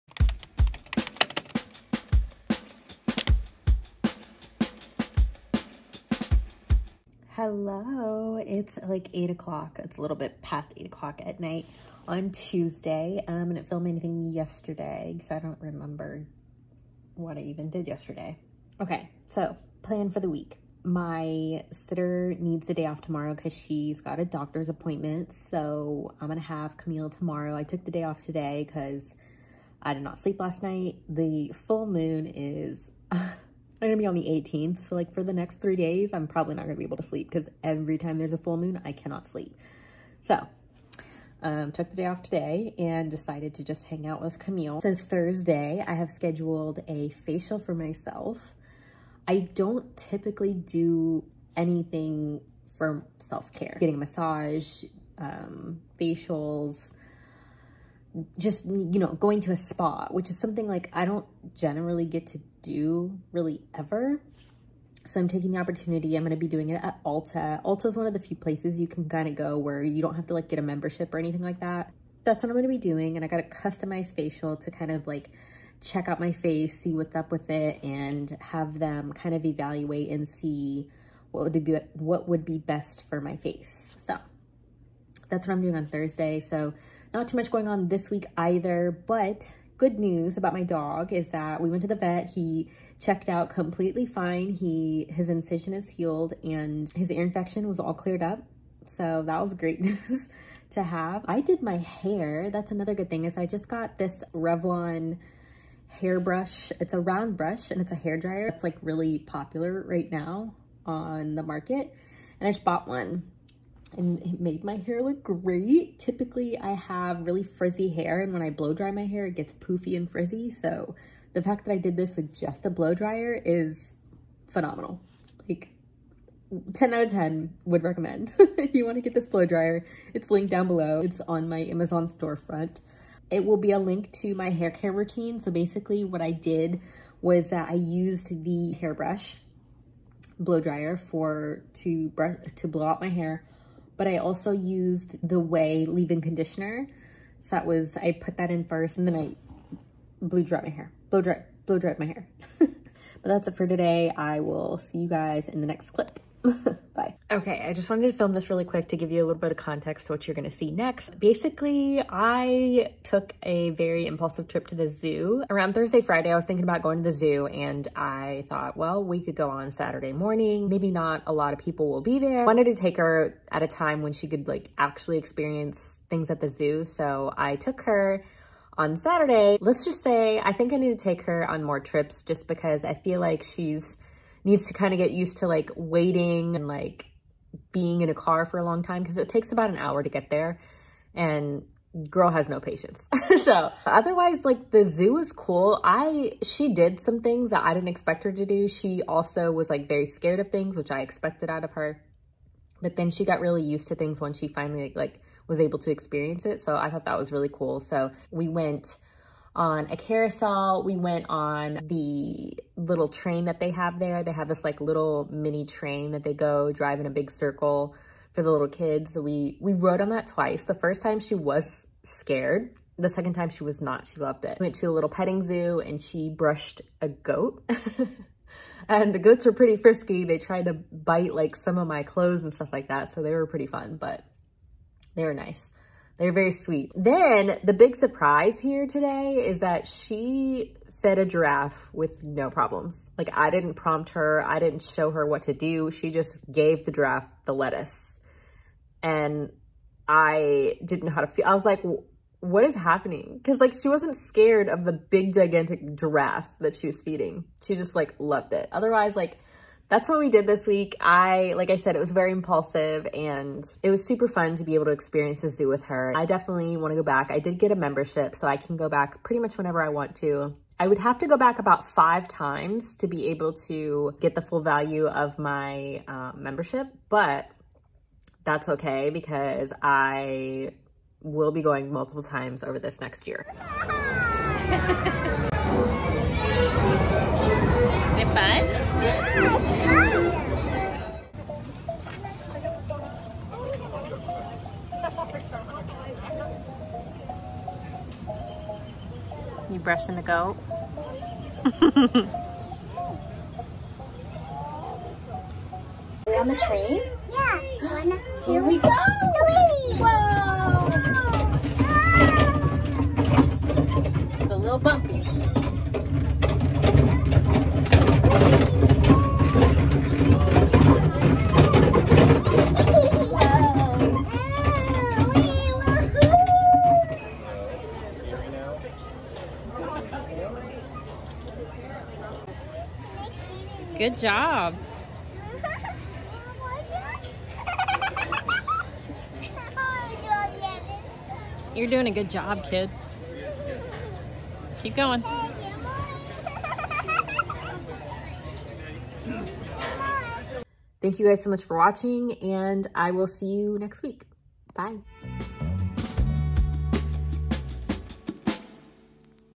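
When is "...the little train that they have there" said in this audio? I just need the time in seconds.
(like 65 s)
211 s.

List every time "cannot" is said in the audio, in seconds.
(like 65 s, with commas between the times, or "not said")
38 s.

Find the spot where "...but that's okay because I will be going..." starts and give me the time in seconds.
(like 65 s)
277 s.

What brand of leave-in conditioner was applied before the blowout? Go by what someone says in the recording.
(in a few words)
Ouai.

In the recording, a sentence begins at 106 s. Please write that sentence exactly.
It's a round brush and it's a hair dryer.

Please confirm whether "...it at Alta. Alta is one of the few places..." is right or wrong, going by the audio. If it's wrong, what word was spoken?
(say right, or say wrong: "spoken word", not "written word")
right.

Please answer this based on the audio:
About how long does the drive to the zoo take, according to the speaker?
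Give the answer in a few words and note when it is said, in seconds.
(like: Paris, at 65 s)
About an hour, at 189 s.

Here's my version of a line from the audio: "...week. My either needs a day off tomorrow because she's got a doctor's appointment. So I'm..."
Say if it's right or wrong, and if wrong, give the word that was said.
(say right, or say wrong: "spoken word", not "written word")
wrong: "sitter", not "either".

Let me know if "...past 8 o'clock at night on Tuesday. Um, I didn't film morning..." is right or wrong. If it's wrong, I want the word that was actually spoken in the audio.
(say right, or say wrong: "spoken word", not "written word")
wrong: "anything", not "morning".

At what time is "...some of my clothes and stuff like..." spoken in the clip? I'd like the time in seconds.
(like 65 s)
231 s.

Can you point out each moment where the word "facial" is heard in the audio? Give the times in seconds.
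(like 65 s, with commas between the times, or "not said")
47 s, 55 s, 74 s.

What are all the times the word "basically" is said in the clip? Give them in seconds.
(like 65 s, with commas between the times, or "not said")
135 s, 161 s.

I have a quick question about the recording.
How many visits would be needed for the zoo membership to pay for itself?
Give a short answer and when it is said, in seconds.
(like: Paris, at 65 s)
5, at 271 s.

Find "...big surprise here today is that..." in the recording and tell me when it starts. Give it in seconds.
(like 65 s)
237 s.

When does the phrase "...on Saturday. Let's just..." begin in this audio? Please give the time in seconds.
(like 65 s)
178 s.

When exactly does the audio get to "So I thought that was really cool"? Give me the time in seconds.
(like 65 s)
206 s.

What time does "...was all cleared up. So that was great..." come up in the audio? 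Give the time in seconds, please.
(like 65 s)
97 s.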